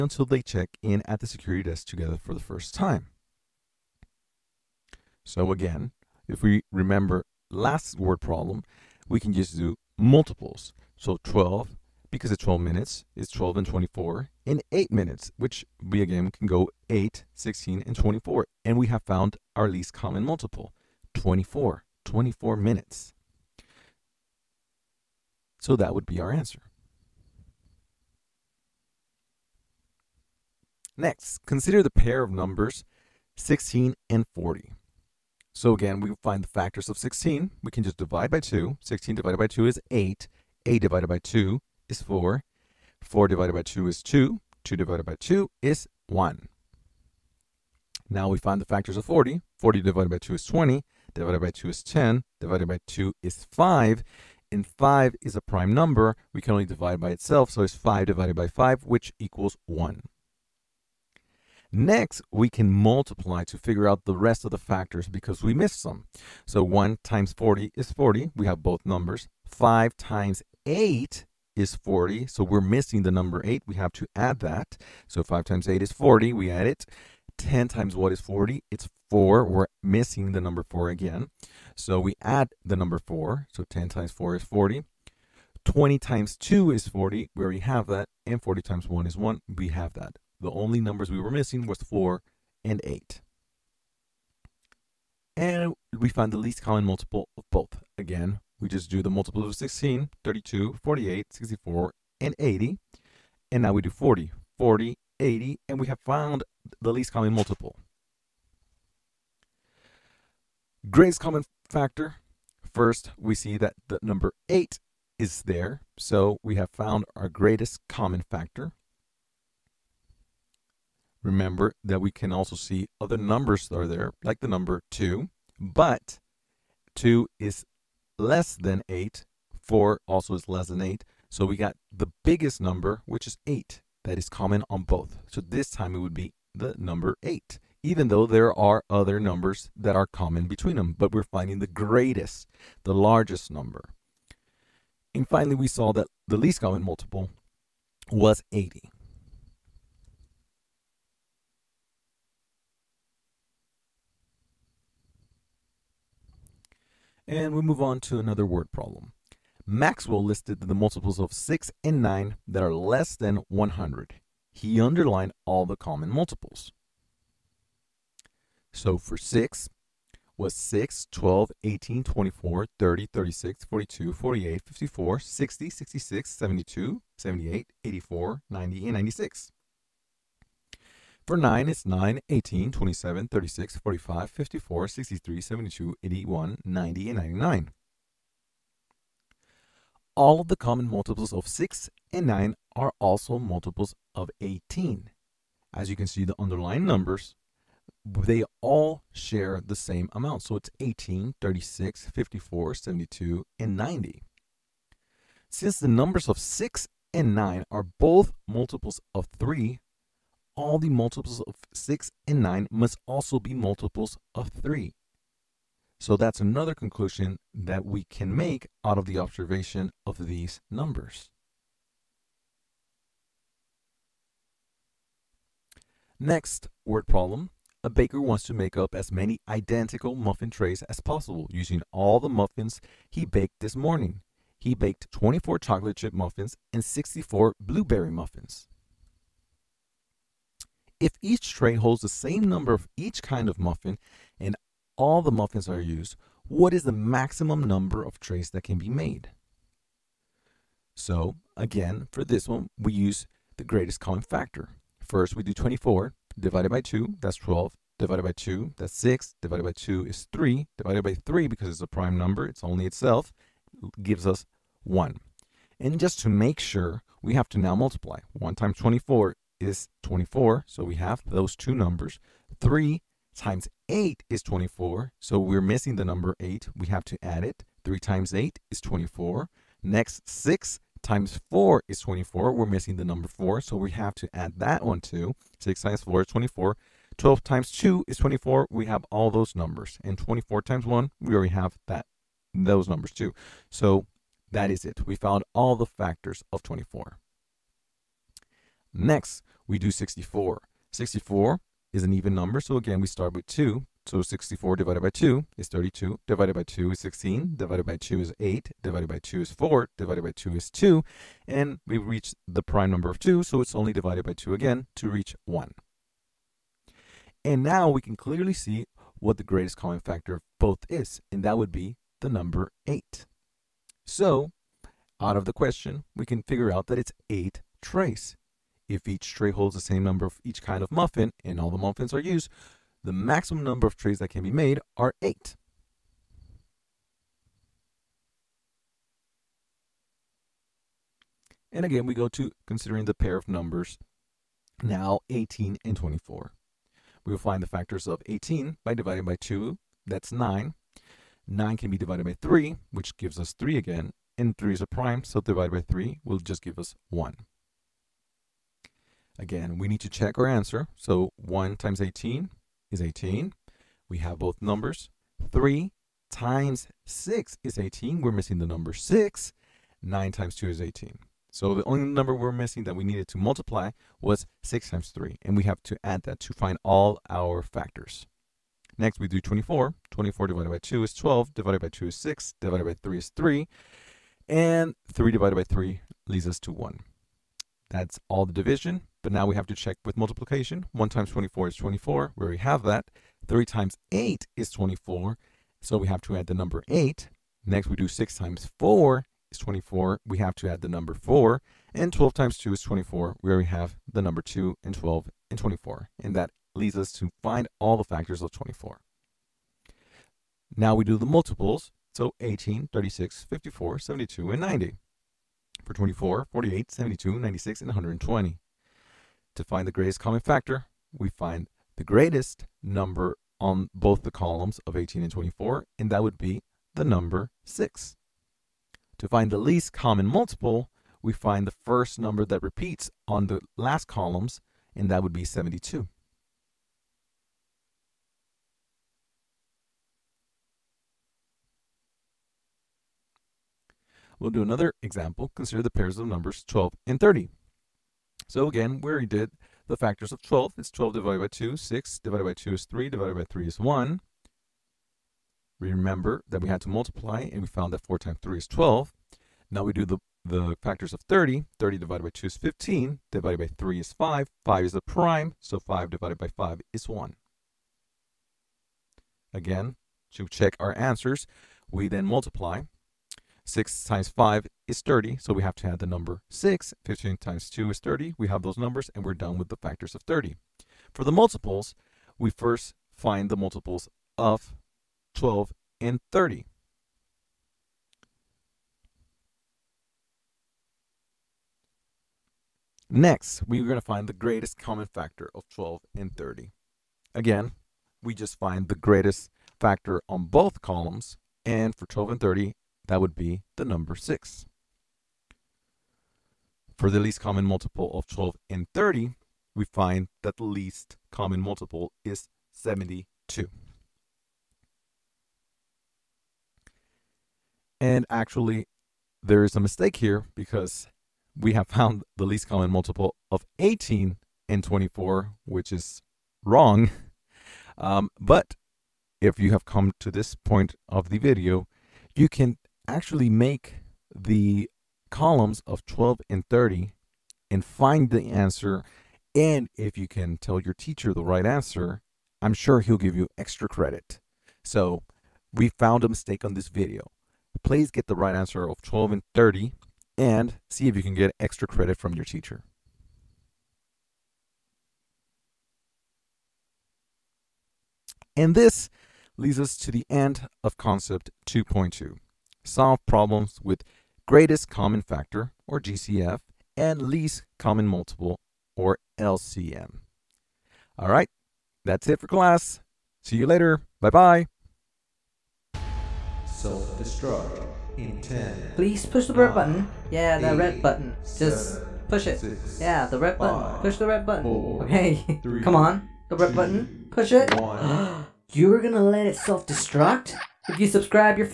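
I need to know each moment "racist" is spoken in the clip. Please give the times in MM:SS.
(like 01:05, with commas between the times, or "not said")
not said.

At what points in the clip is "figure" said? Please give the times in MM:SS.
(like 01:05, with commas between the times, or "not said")
01:03, 05:26.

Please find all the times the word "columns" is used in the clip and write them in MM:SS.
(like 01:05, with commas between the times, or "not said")
07:04, 07:14, 08:20, 08:55.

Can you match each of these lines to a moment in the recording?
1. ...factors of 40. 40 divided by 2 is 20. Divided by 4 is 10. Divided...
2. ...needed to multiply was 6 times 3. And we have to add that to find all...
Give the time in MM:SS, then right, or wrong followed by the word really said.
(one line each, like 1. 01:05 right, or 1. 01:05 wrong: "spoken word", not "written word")
1. 00:48 wrong: "2", not "4"
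2. 06:13 right.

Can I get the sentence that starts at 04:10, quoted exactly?
So again, for this one, we use the greatest common factor.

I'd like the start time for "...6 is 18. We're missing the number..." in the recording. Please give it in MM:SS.
06:07.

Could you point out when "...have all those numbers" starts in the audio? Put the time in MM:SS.
04:48.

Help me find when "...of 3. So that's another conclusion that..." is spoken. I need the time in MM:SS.
03:34.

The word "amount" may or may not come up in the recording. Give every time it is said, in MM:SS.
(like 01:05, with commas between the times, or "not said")
03:20.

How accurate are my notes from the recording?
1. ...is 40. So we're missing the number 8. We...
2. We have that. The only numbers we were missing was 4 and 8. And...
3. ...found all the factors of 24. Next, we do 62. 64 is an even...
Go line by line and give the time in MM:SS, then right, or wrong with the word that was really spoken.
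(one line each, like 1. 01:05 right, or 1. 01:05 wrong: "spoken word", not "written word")
1. 01:11 right
2. 01:29 right
3. 04:55 wrong: "64", not "62".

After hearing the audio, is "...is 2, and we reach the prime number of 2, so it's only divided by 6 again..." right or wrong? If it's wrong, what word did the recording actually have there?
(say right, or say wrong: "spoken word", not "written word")
wrong: "2", not "6".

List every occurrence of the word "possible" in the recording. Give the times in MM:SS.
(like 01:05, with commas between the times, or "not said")
03:50.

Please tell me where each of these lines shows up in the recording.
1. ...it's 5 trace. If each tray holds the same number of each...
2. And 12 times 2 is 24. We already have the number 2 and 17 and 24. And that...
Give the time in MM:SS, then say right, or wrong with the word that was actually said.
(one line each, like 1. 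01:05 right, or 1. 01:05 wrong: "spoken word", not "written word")
1. 05:26 wrong: "8", not "5"
2. 06:41 wrong: "12", not "17".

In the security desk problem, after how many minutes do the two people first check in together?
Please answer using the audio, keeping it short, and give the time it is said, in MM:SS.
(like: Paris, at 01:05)
24 minutes, at 00:22.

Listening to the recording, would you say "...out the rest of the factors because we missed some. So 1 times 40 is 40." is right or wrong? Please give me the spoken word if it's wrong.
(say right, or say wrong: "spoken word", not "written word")
right.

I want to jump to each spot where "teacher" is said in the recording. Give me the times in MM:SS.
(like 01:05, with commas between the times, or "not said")
09:00, 09:12.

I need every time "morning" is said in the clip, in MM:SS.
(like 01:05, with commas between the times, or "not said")
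03:53.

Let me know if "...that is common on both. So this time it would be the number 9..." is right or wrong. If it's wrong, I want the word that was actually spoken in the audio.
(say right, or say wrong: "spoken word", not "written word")
wrong: "8", not "9".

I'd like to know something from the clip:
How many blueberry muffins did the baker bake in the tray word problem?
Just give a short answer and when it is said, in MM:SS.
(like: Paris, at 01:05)
64, at 03:56.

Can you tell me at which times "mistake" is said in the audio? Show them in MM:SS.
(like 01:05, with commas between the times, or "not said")
08:39, 09:06.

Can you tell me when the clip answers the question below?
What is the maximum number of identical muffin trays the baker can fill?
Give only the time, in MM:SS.
05:35.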